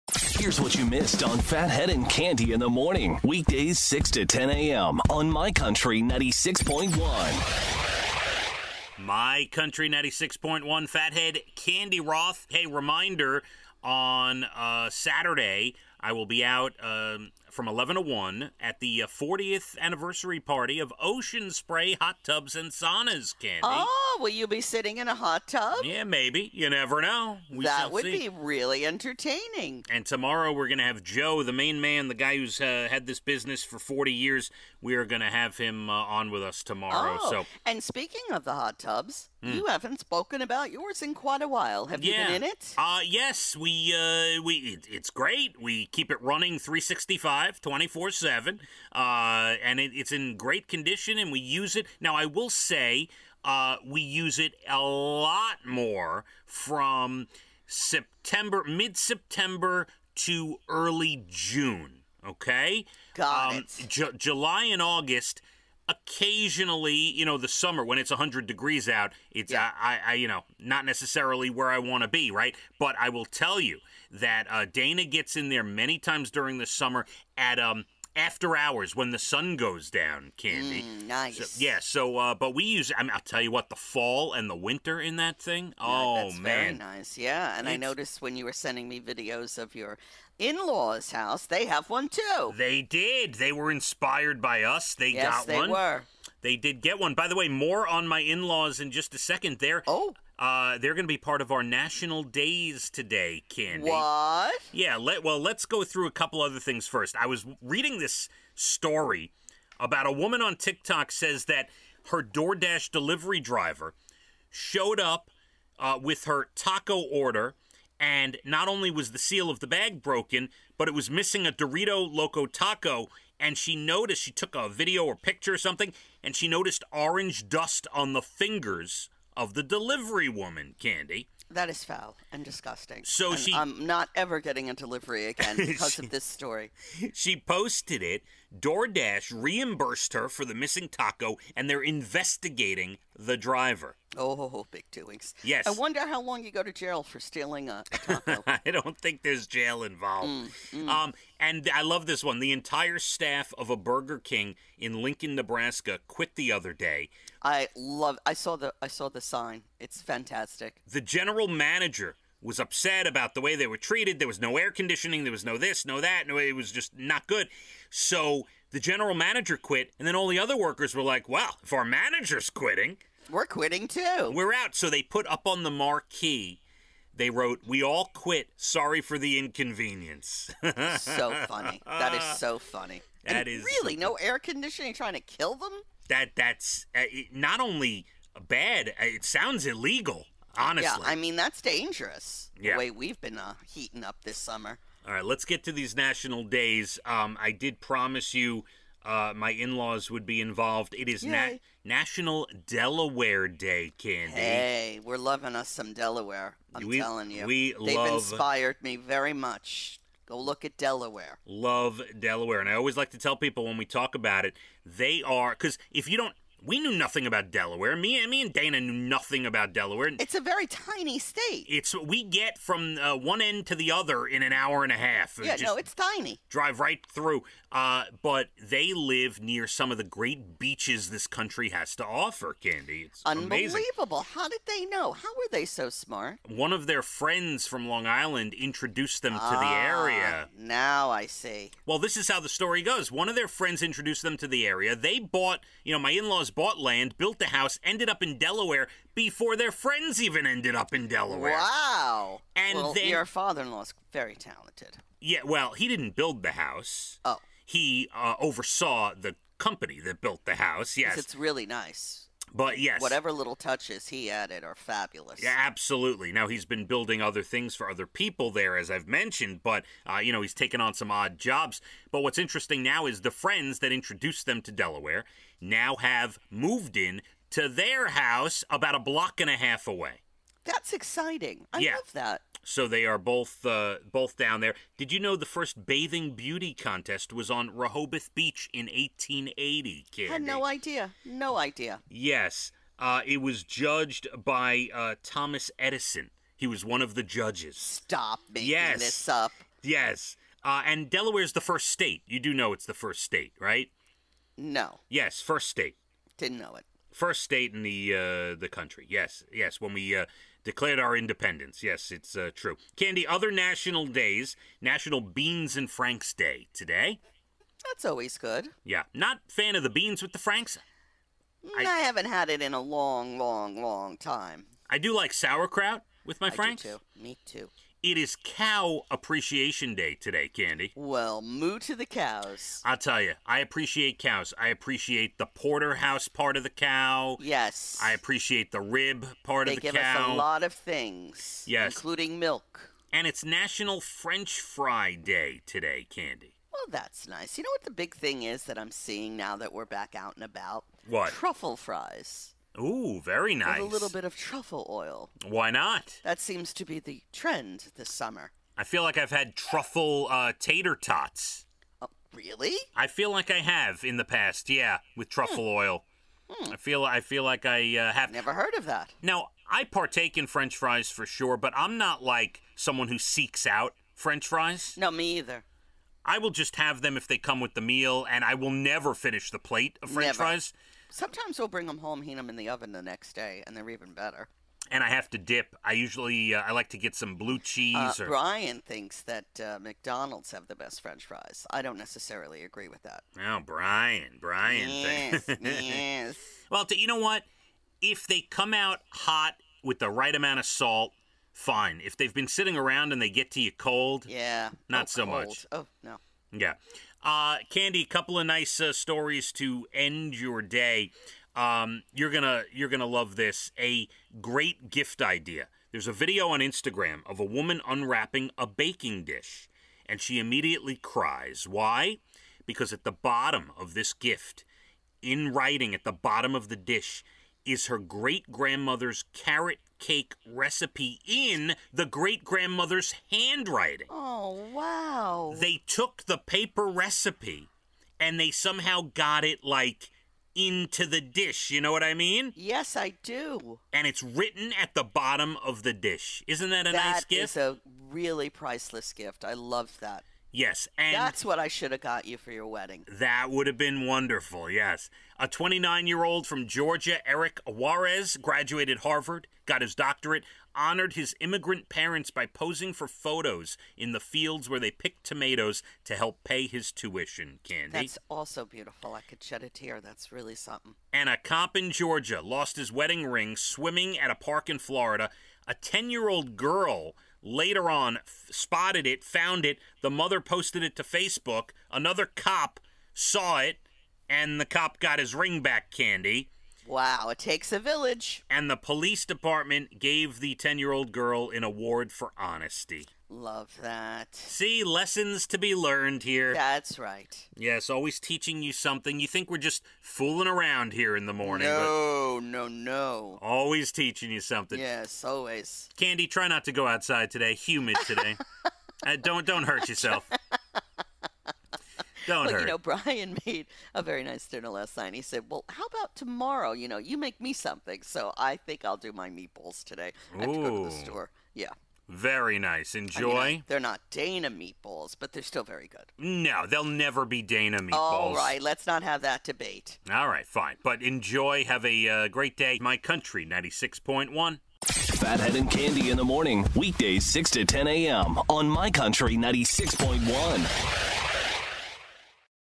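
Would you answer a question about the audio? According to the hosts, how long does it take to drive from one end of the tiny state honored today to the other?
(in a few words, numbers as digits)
an hour and a half.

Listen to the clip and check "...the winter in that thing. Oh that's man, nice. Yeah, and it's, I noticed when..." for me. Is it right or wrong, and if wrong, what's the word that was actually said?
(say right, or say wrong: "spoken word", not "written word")
right.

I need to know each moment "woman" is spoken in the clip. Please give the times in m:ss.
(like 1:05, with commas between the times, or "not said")
1:50, 2:10, 6:57.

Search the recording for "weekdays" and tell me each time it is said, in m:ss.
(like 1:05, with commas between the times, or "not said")
0:03, 8:56.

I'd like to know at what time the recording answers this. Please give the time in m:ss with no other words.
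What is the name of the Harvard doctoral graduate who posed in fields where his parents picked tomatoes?
7:37.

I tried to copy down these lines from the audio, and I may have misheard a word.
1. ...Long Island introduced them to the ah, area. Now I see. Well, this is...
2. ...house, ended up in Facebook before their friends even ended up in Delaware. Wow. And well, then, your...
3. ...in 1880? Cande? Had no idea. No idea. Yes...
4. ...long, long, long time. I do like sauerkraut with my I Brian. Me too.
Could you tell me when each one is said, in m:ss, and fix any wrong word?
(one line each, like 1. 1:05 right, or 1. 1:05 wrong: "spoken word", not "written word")
1. 3:57 right
2. 4:07 wrong: "Delaware", not "Facebook"
3. 4:48 right
4. 5:22 wrong: "Franks", not "Brian".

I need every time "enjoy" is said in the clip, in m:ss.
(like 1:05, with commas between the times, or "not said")
8:42, 8:51.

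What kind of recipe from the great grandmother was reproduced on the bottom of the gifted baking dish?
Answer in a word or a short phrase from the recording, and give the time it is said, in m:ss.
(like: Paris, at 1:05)
carrot cake, at 7:09.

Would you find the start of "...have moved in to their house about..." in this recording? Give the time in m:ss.
4:35.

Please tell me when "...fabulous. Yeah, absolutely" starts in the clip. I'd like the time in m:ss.
4:24.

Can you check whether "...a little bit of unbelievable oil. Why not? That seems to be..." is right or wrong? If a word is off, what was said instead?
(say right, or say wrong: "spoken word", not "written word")
wrong: "truffle", not "unbelievable".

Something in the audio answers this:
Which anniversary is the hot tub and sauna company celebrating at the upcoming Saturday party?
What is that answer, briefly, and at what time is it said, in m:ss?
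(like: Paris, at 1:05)
40th, at 0:19.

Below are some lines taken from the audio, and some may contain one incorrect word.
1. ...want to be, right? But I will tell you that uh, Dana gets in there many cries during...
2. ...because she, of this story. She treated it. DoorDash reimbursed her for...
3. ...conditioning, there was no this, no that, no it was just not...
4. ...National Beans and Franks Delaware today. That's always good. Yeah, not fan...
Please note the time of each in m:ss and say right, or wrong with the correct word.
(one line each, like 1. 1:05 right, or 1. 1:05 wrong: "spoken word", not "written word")
1. 1:11 wrong: "times", not "cries"
2. 2:15 wrong: "posted", not "treated"
3. 2:44 right
4. 5:14 wrong: "Day", not "Delaware".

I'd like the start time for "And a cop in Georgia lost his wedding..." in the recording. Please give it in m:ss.
7:51.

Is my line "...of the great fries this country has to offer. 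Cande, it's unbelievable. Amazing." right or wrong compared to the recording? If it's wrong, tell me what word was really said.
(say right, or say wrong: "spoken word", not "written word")
wrong: "beaches", not "fries".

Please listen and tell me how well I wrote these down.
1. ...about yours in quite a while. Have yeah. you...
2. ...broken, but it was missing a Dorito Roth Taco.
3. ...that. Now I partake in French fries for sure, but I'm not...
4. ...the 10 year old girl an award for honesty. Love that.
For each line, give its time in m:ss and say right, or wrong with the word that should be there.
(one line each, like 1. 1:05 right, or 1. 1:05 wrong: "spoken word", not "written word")
1. 0:40 right
2. 2:00 wrong: "Loco", not "Roth"
3. 6:08 right
4. 8:10 right.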